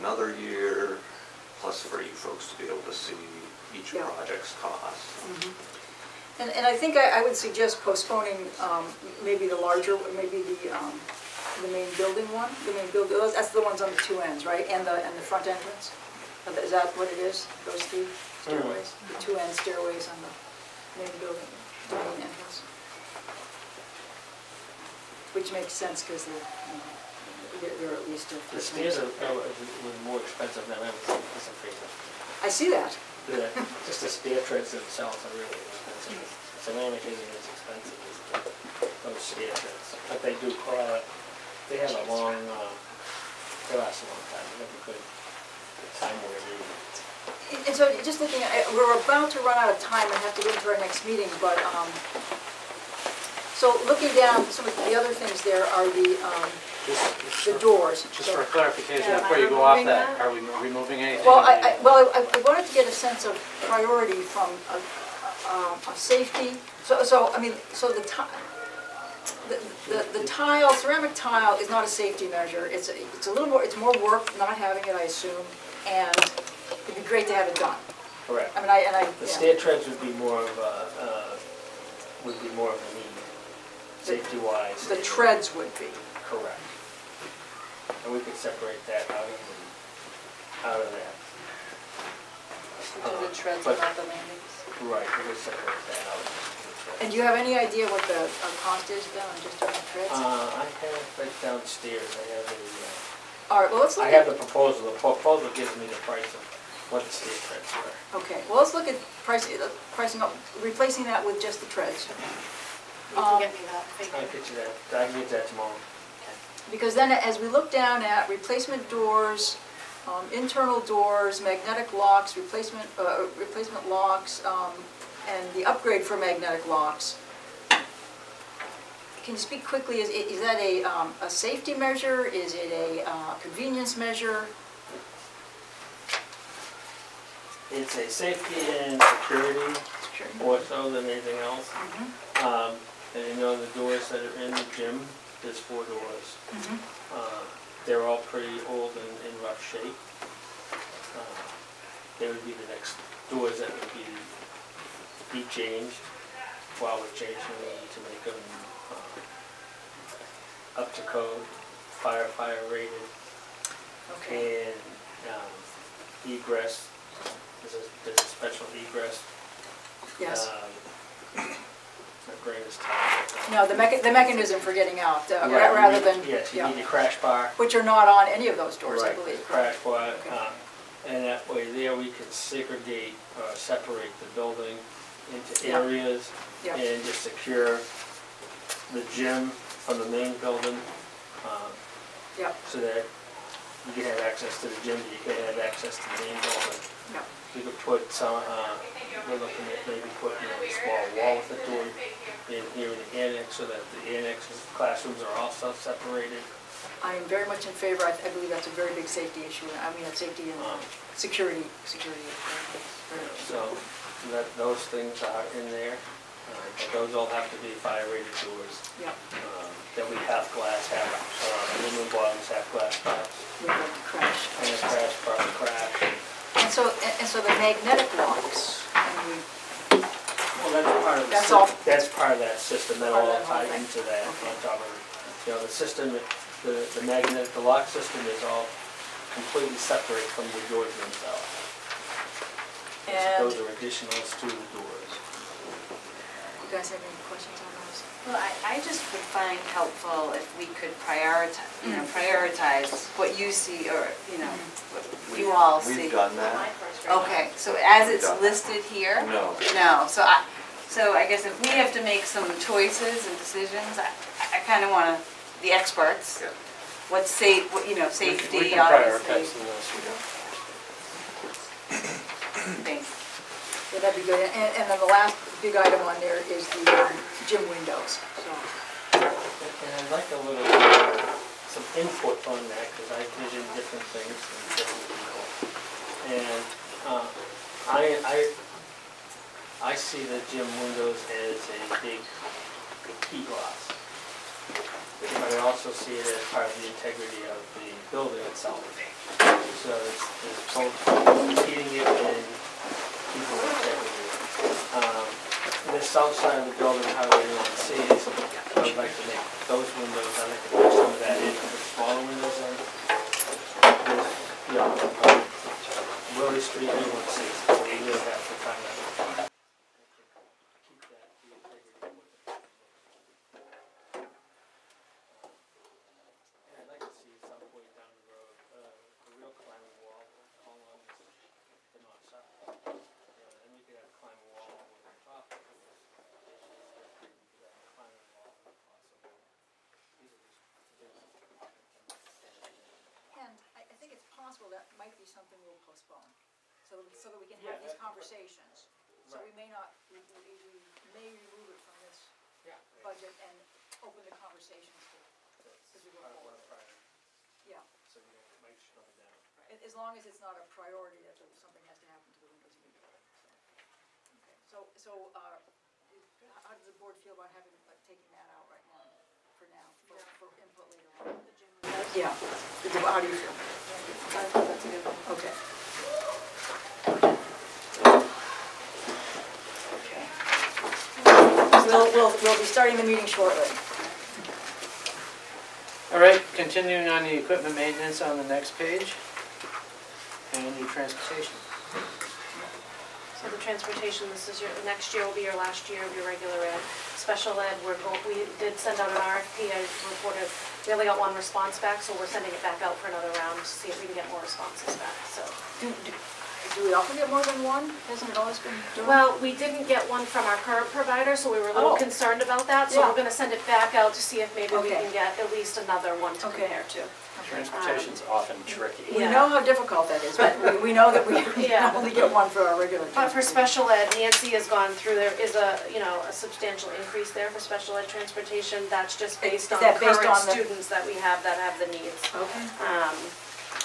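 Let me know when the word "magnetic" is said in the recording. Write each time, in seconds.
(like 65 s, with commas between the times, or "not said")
121 s, 126 s, 227 s, 237 s.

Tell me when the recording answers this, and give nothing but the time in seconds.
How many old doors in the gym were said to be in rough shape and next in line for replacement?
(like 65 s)
145 s.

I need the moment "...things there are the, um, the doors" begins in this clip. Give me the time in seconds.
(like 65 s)
55 s.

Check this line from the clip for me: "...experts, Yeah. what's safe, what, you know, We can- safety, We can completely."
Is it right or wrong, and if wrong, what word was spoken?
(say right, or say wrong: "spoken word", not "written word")
wrong: "obviously", not "completely".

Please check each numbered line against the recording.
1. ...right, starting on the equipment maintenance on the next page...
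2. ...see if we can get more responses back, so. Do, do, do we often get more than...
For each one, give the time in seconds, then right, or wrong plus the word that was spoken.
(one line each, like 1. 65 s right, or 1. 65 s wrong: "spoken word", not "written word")
1. 386 s wrong: "continuing", not "starting"
2. 403 s right.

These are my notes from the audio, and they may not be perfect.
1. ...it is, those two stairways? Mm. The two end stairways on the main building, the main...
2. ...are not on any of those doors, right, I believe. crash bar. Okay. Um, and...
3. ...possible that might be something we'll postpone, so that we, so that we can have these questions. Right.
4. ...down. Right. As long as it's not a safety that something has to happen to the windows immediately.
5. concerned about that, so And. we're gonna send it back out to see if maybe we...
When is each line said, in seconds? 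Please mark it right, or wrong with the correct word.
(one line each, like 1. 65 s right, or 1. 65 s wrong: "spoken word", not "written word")
1. 17 s right
2. 177 s right
3. 344 s wrong: "conversations", not "questions"
4. 359 s wrong: "priority", not "safety"
5. 411 s wrong: "Yeah", not "And".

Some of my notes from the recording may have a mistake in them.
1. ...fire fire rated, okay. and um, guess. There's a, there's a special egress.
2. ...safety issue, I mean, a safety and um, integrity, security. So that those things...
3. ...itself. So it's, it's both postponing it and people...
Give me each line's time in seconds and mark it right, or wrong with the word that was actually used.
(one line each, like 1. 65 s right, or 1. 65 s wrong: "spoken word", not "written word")
1. 162 s wrong: "egress", not "guess"
2. 209 s wrong: "security", not "integrity"
3. 298 s wrong: "heating", not "postponing".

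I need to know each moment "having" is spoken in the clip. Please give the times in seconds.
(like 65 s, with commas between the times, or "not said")
74 s, 367 s.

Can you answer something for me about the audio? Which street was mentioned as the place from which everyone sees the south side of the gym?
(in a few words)
Willie Street.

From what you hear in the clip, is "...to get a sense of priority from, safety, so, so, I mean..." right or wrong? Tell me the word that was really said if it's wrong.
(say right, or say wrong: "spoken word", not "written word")
right.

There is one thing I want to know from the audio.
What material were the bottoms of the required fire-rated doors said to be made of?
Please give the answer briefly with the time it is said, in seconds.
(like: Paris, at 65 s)
aluminum, at 221 s.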